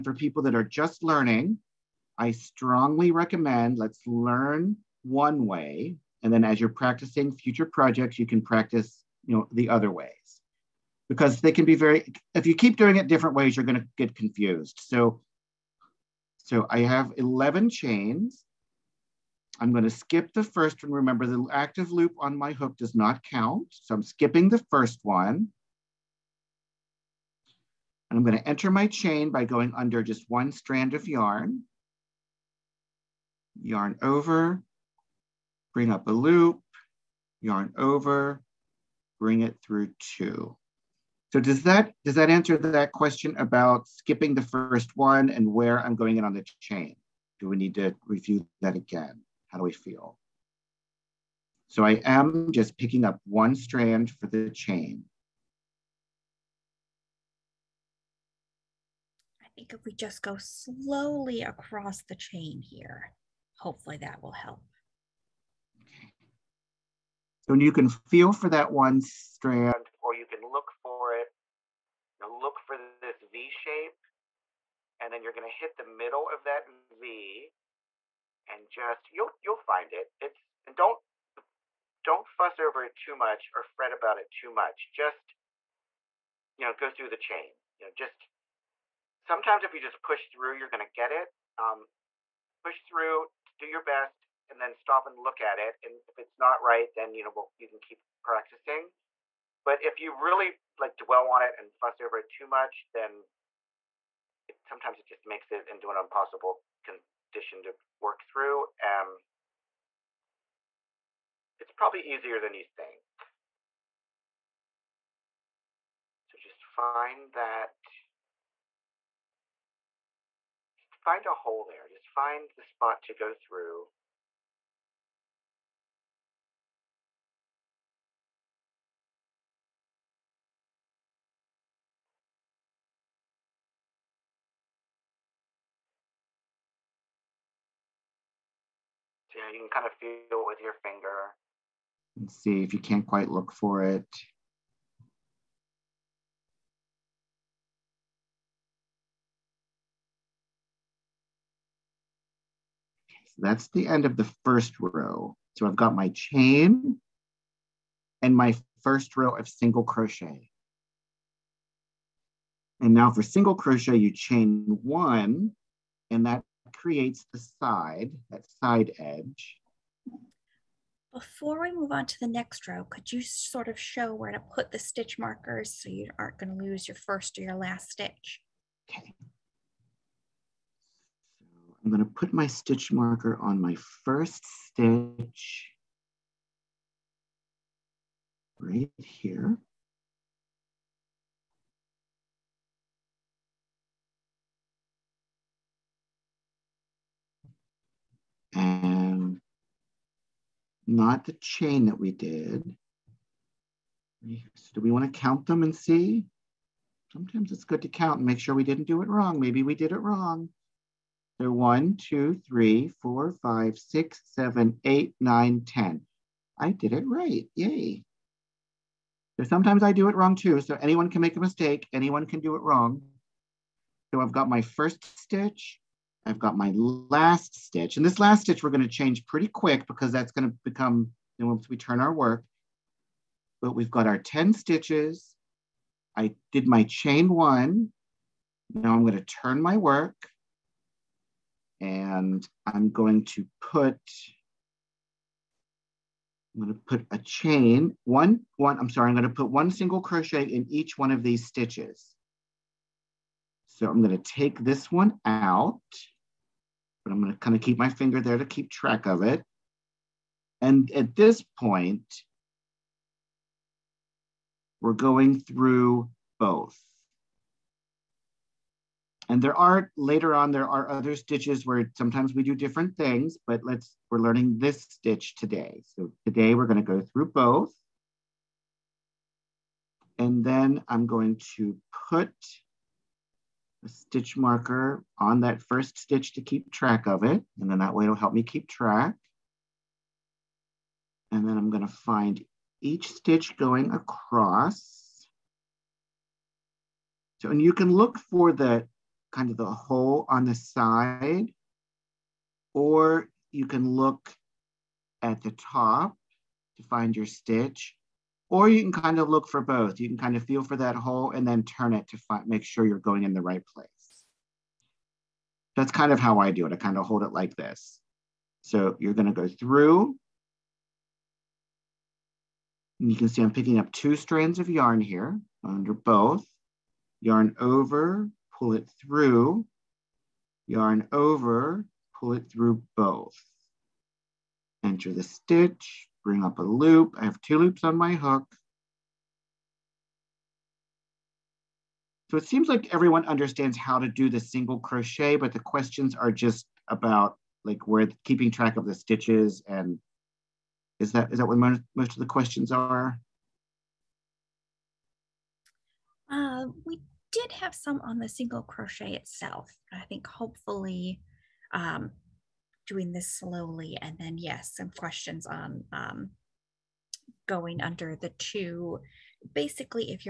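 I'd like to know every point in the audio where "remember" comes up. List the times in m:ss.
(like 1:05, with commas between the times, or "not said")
0:20.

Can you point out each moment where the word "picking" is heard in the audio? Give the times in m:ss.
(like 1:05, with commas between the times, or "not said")
0:52, 5:23.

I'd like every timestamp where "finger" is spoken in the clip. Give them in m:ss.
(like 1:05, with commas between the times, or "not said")
2:20, 4:17.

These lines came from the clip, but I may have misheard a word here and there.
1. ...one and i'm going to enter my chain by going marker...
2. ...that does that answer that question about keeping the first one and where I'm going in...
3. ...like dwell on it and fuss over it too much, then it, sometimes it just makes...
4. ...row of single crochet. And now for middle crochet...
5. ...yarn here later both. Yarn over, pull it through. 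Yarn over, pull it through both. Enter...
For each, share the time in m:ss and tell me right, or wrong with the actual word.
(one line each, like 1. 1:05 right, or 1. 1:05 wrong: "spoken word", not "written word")
1. 0:25 wrong: "under", not "marker"
2. 0:41 wrong: "skipping", not "keeping"
3. 1:40 right
4. 2:39 wrong: "single", not "middle"
5. 5:24 wrong: "under", not "later".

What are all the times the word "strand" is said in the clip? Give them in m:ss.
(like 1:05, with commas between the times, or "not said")
0:30, 0:53, 1:09, 5:24.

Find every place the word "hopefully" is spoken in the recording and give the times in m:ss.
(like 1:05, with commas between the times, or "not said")
1:03, 6:00.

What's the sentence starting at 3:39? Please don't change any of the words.
So sometimes I do it wrong too.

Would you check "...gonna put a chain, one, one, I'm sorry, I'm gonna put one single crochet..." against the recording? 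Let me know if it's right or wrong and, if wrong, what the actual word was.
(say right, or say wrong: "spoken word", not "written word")
right.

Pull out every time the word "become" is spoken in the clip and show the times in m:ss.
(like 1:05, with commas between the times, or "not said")
3:50.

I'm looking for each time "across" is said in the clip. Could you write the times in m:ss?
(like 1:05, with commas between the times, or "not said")
1:01, 4:53.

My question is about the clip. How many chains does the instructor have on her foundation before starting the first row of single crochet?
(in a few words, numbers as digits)
11.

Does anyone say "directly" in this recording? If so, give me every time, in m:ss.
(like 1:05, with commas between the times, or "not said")
not said.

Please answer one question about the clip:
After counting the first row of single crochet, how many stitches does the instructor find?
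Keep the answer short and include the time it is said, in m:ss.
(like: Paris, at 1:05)
10, at 3:35.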